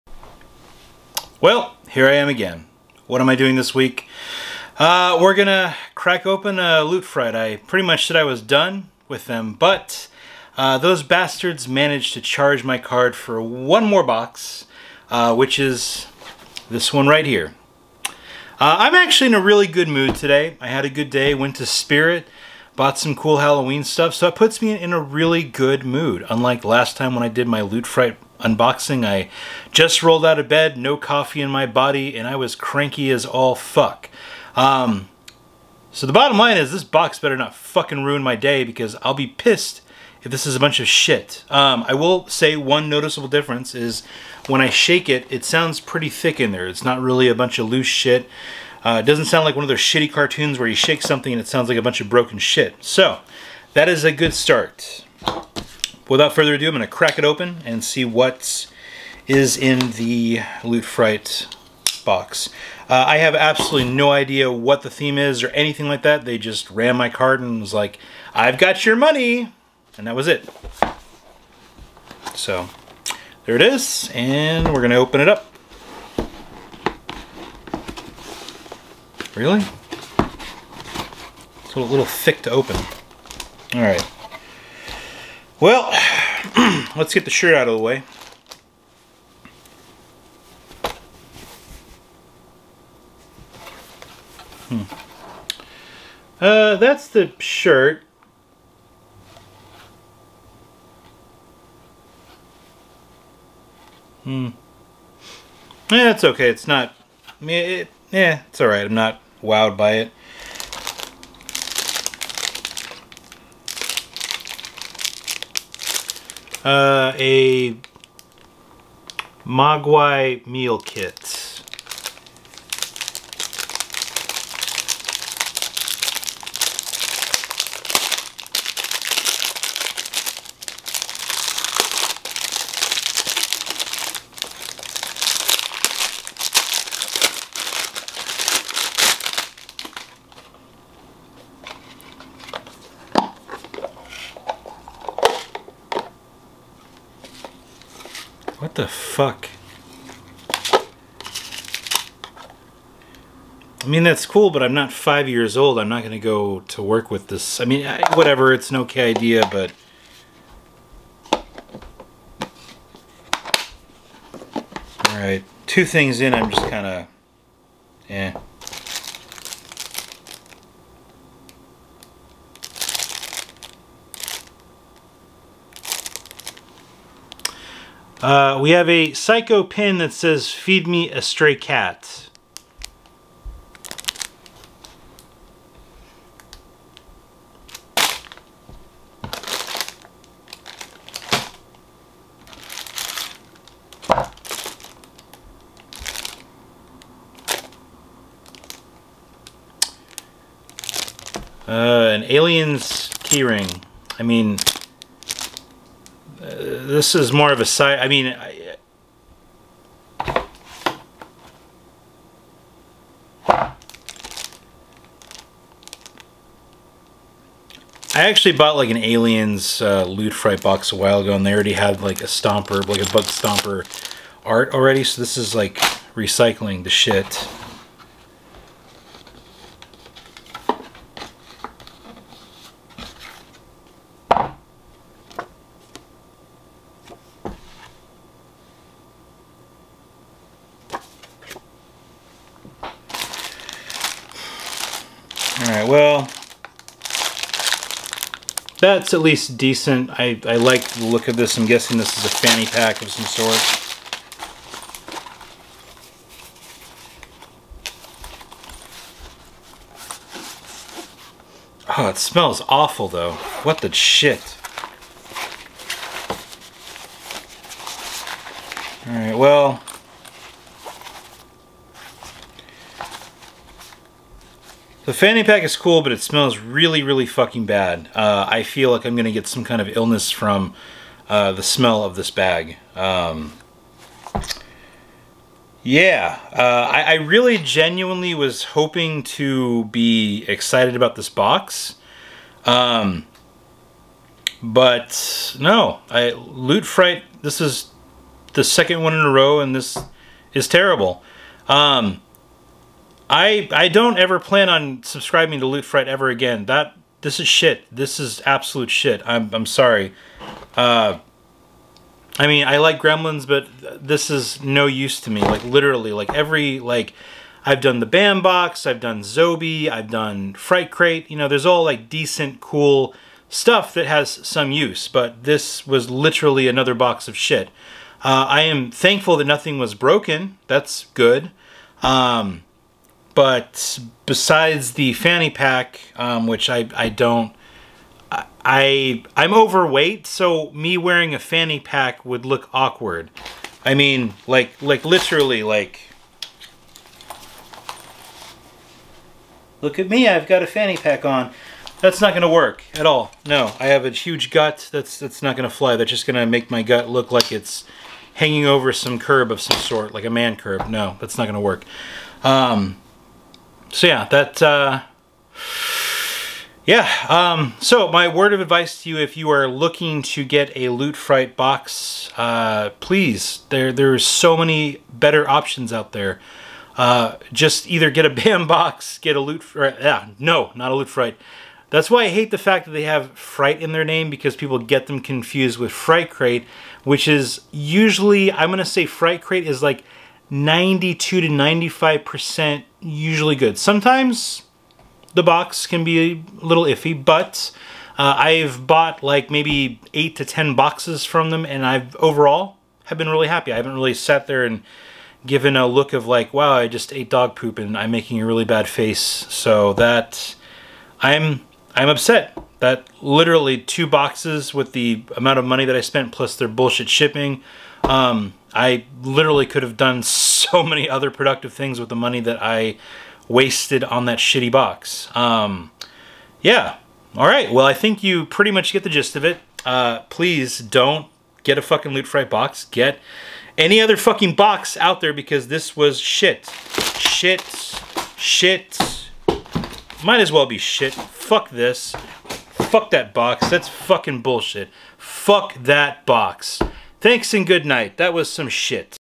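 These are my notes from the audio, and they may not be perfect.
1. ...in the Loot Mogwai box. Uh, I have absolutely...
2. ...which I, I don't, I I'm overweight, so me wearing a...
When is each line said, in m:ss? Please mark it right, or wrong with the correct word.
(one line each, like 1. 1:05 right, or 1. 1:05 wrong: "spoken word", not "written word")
1. 0:59 wrong: "Fright", not "Mogwai"
2. 5:36 right.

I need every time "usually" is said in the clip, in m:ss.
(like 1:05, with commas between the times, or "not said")
6:27, 6:32.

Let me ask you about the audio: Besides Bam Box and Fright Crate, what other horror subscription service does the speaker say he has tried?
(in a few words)
Zobie.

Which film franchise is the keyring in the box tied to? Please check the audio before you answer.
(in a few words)
Aliens.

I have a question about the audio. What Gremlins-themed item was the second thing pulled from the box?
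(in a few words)
Mogwai meal kit.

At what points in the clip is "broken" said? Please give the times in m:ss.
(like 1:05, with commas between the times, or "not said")
0:52, 5:29.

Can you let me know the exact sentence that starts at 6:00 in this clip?
No, that's not going to work.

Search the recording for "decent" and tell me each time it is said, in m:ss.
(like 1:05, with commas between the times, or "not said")
4:09, 5:22.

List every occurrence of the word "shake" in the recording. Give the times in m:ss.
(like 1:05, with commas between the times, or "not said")
0:44, 0:50.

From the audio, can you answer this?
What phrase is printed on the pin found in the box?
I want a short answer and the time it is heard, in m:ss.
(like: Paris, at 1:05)
Feed me a stray cat, at 3:00.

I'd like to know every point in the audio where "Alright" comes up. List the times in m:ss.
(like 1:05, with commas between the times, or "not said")
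2:45, 4:29.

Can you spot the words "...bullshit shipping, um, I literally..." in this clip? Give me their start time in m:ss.
6:56.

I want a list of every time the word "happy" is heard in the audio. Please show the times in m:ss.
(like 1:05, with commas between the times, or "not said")
6:43.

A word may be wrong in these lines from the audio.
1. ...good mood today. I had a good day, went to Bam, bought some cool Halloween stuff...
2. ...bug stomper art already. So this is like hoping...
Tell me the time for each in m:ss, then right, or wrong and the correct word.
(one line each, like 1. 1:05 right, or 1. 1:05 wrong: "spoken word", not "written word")
1. 0:19 wrong: "Spirit", not "Bam"
2. 3:43 wrong: "recycling", not "hoping".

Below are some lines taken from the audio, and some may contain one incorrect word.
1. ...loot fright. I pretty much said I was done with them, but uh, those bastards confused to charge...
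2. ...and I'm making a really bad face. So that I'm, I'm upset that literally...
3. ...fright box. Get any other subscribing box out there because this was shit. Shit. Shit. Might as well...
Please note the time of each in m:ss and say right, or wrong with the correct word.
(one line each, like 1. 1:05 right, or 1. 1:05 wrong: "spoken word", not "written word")
1. 0:06 wrong: "managed", not "confused"
2. 6:47 right
3. 7:12 wrong: "fucking", not "subscribing".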